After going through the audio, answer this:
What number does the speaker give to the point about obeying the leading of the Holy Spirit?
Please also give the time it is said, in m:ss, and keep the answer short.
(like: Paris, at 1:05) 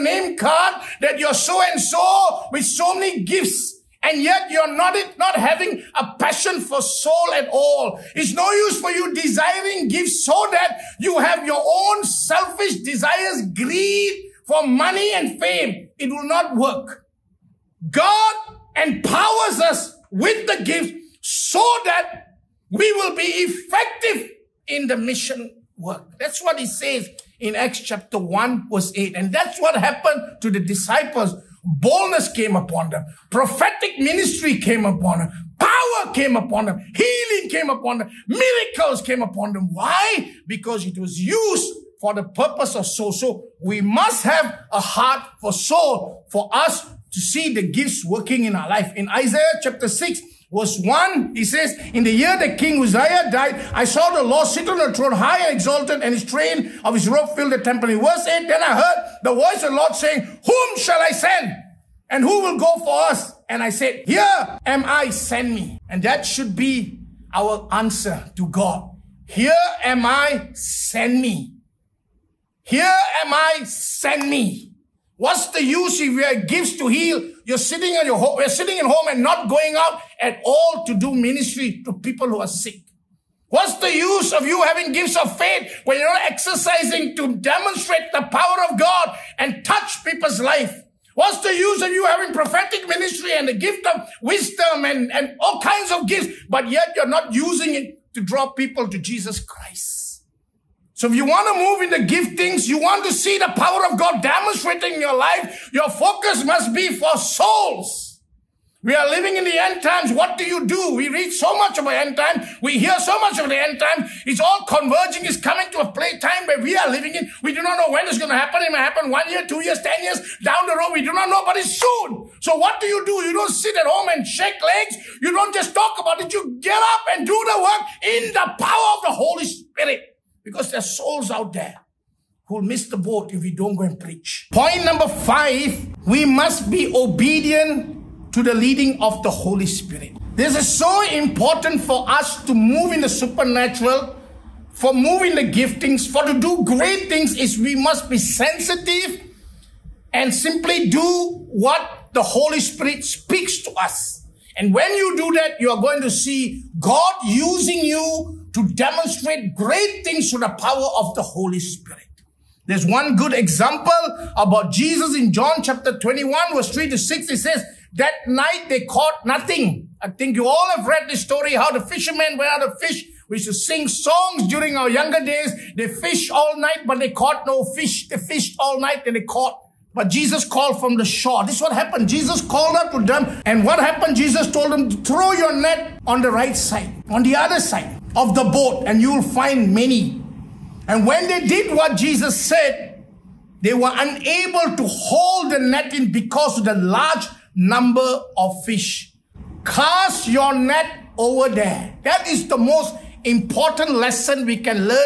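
5, at 2:15.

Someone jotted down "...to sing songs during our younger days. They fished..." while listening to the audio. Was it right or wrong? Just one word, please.
right.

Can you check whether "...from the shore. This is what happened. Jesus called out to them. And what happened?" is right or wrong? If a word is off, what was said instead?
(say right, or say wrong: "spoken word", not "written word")
right.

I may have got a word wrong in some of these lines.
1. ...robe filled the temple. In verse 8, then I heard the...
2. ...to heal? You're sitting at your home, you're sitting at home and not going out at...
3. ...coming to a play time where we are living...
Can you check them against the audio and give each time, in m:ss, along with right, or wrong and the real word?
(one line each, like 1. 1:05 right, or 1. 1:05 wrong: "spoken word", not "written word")
1. 0:57 right
2. 1:16 right
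3. 1:55 right.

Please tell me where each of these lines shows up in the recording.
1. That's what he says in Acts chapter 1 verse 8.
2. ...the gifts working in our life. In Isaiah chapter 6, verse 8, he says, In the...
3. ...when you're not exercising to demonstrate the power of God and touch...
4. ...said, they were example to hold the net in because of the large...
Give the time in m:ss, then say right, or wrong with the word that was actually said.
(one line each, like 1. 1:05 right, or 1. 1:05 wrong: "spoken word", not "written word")
1. 0:26 right
2. 0:47 wrong: "1", not "8"
3. 1:25 right
4. 3:12 wrong: "unable", not "example".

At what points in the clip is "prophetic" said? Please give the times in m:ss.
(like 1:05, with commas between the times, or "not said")
0:33, 1:32.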